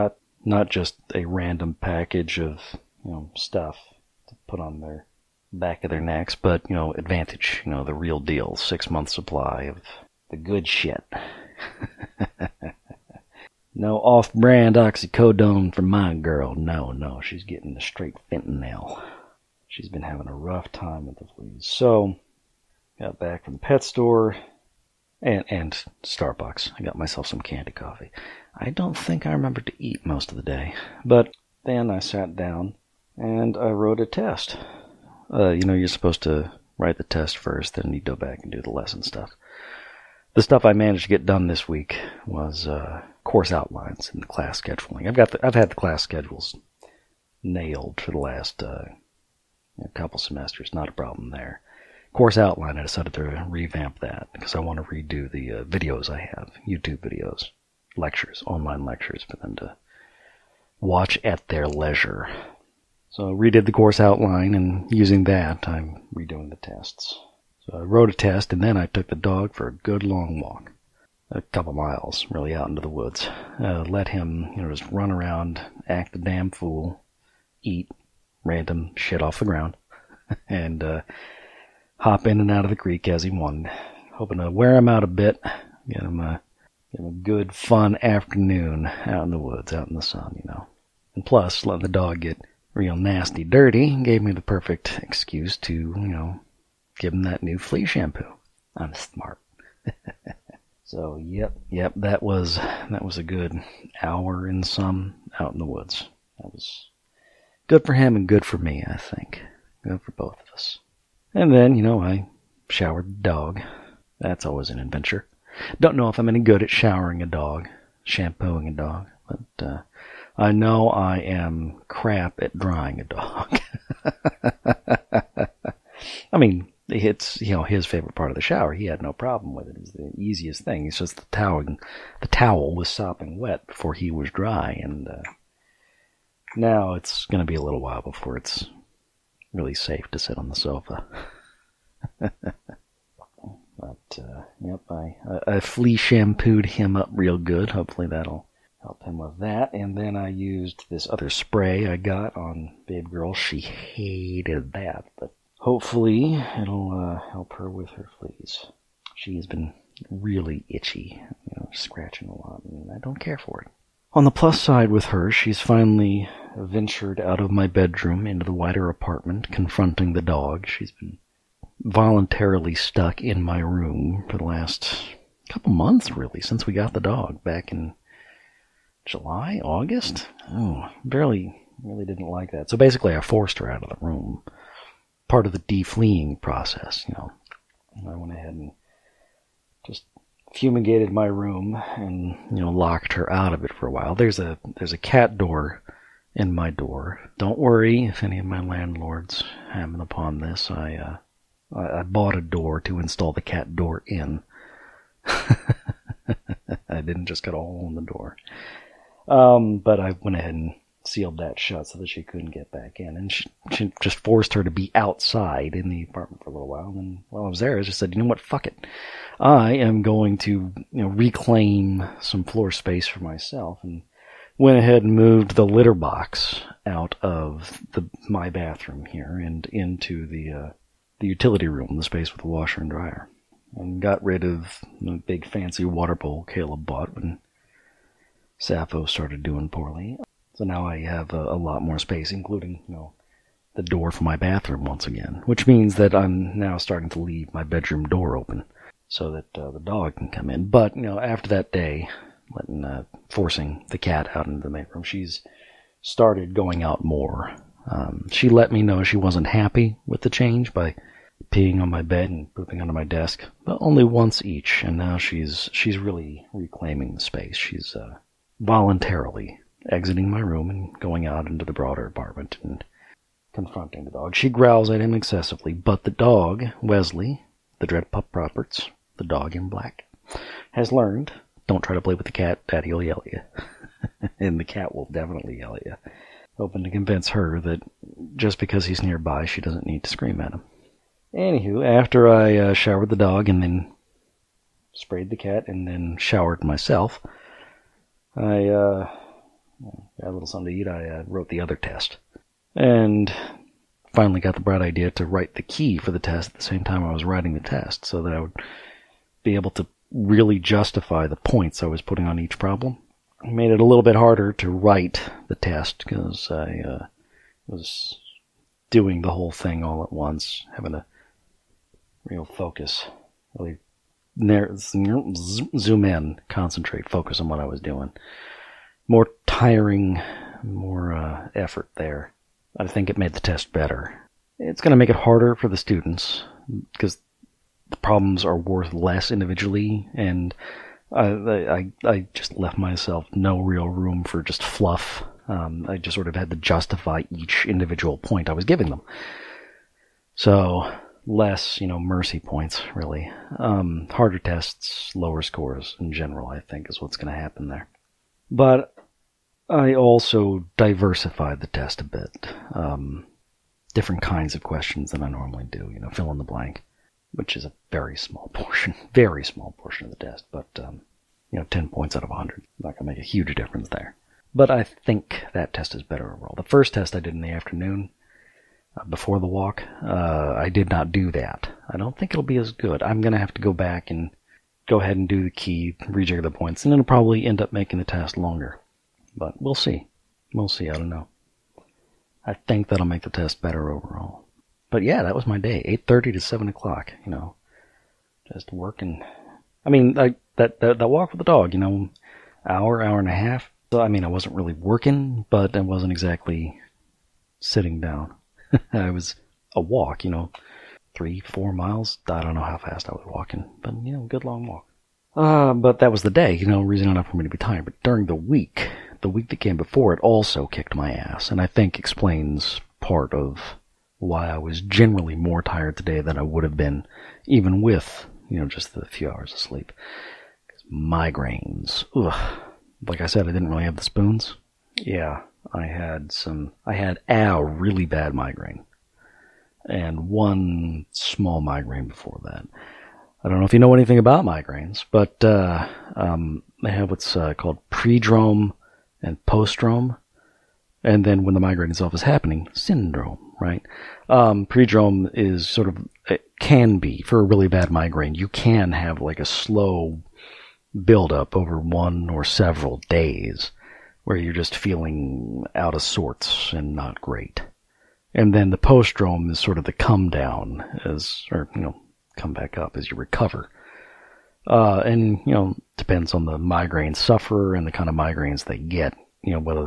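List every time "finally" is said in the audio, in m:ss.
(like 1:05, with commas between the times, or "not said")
2:45, 5:04.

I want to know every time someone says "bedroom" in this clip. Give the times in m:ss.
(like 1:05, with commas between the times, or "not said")
2:47, 4:07.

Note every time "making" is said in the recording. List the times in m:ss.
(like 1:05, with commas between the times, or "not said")
6:27.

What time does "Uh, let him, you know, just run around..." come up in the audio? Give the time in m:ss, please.
1:13.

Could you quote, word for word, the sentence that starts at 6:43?
So, I mean, I wasn't really working, but I wasn't exactly sitting down.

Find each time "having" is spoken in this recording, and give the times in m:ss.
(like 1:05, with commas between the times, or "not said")
0:20, 5:20.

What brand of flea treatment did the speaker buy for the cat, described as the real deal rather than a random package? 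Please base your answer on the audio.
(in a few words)
Advantage.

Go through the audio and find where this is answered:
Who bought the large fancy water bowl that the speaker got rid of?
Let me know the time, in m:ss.
3:56.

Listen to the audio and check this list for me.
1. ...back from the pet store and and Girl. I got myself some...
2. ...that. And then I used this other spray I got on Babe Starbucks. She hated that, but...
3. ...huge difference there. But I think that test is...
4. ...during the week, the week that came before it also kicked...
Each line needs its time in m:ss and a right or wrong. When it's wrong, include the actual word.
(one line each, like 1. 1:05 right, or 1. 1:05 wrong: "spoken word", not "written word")
1. 0:23 wrong: "Starbucks", not "Girl"
2. 2:29 wrong: "Girl", not "Starbucks"
3. 6:13 right
4. 6:58 right.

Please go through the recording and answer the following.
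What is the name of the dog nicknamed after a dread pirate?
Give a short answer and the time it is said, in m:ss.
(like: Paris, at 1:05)
Wesley, at 4:36.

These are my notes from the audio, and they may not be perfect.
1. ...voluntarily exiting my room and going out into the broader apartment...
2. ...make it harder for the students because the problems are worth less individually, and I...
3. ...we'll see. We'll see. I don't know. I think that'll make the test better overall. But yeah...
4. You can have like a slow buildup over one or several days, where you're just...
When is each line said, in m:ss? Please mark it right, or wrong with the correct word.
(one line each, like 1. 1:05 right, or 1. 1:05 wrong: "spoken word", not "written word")
1. 4:28 right
2. 5:34 right
3. 6:29 right
4. 7:38 right.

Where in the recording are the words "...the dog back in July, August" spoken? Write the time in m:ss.
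2:56.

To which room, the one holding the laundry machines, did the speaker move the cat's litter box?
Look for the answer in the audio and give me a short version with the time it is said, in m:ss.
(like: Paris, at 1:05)
utility room, at 3:51.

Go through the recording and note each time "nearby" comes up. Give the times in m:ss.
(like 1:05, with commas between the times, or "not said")
4:49.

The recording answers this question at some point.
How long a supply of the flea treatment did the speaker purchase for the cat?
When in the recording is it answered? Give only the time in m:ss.
0:08.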